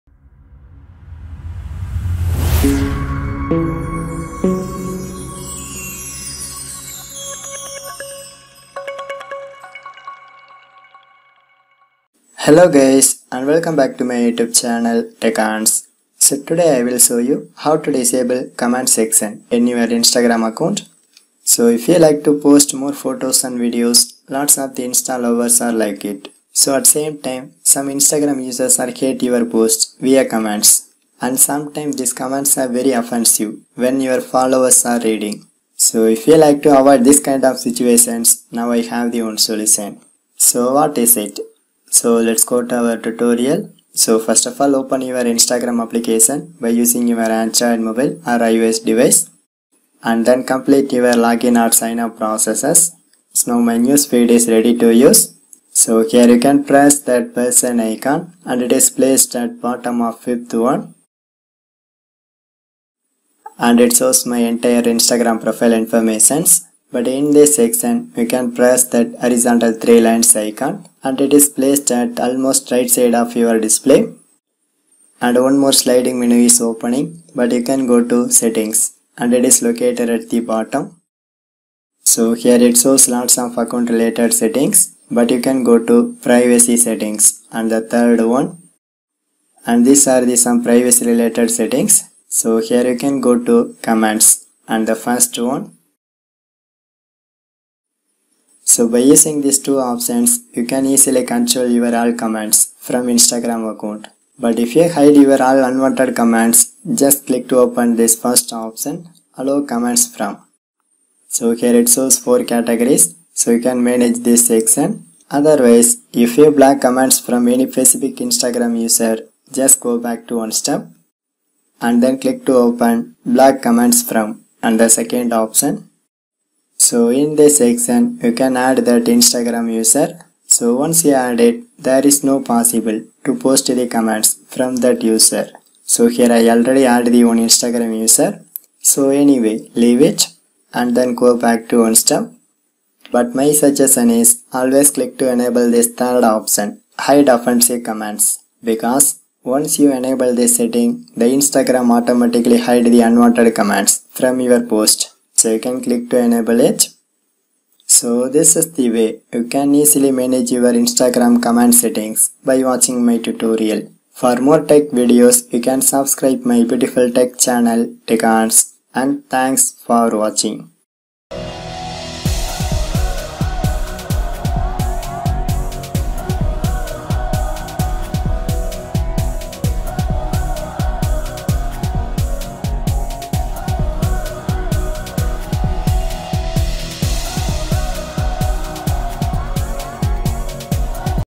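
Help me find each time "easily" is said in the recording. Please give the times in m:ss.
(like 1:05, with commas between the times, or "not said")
1:40, 2:39.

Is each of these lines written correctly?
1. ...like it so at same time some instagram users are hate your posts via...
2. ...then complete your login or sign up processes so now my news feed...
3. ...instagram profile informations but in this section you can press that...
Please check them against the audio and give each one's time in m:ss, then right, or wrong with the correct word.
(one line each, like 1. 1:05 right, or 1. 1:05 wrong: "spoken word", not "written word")
1. 0:25 right
2. 0:50 right
3. 1:04 right.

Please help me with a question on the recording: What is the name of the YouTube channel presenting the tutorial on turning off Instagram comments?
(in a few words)
Teconz.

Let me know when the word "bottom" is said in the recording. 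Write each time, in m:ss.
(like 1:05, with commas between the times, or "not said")
0:59, 1:20.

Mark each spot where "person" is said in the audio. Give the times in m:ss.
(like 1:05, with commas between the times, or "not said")
0:57.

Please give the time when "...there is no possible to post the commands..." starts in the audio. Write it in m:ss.
2:11.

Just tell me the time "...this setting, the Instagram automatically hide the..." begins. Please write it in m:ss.
2:30.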